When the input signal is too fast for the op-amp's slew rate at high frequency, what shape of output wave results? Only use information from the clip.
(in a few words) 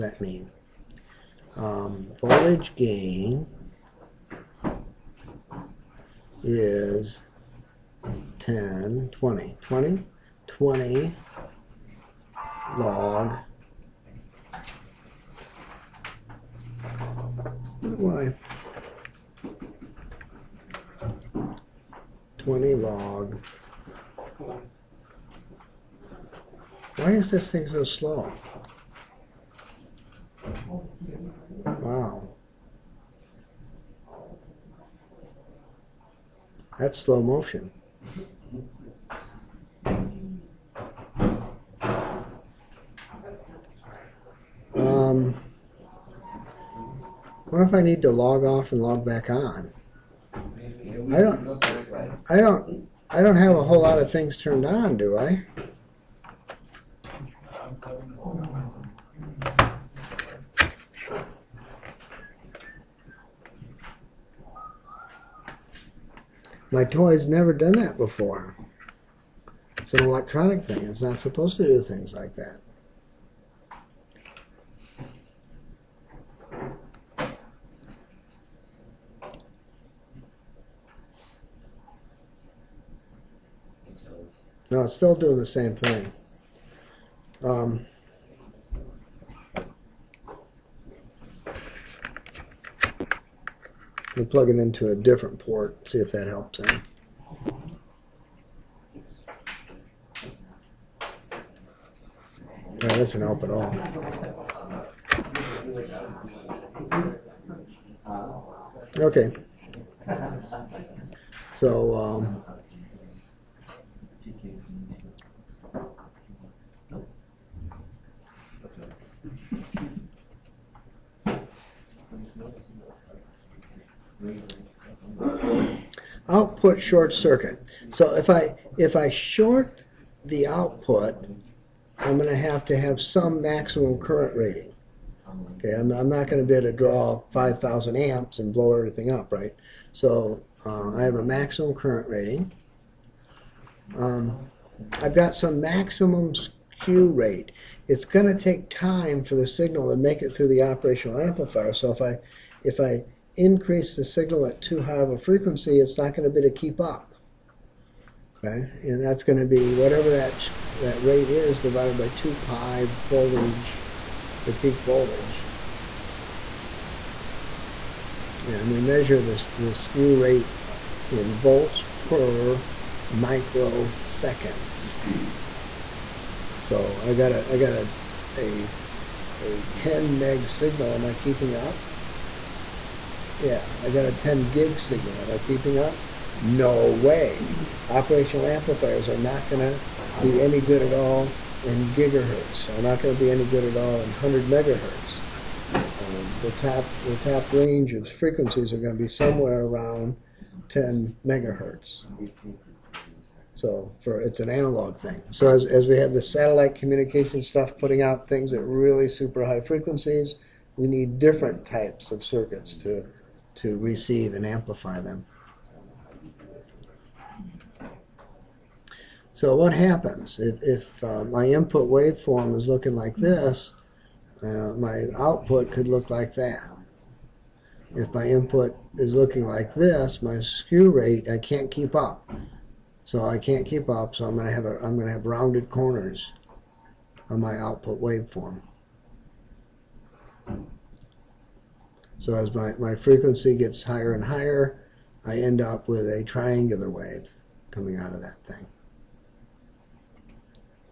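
triangular wave.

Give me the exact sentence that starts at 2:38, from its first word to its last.
Okay, and that's going to be whatever that that rate is divided by 2 pi voltage, the peak voltage.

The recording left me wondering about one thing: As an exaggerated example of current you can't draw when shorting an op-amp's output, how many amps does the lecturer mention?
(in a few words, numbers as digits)
5,000.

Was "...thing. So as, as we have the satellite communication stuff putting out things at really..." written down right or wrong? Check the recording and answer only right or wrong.
right.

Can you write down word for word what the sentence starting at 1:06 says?
My toy's never done that before.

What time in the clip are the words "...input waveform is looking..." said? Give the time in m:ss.
3:41.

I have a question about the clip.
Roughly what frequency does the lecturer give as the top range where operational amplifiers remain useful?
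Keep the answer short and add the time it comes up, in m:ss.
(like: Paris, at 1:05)
10 MHz, at 3:20.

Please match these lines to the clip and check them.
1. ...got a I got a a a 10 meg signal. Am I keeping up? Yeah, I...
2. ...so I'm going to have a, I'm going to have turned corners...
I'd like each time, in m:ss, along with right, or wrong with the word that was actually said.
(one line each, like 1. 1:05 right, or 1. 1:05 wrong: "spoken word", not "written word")
1. 2:57 right
2. 3:54 wrong: "rounded", not "turned".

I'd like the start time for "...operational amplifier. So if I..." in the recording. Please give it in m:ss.
2:30.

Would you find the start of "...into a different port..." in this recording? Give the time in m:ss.
1:34.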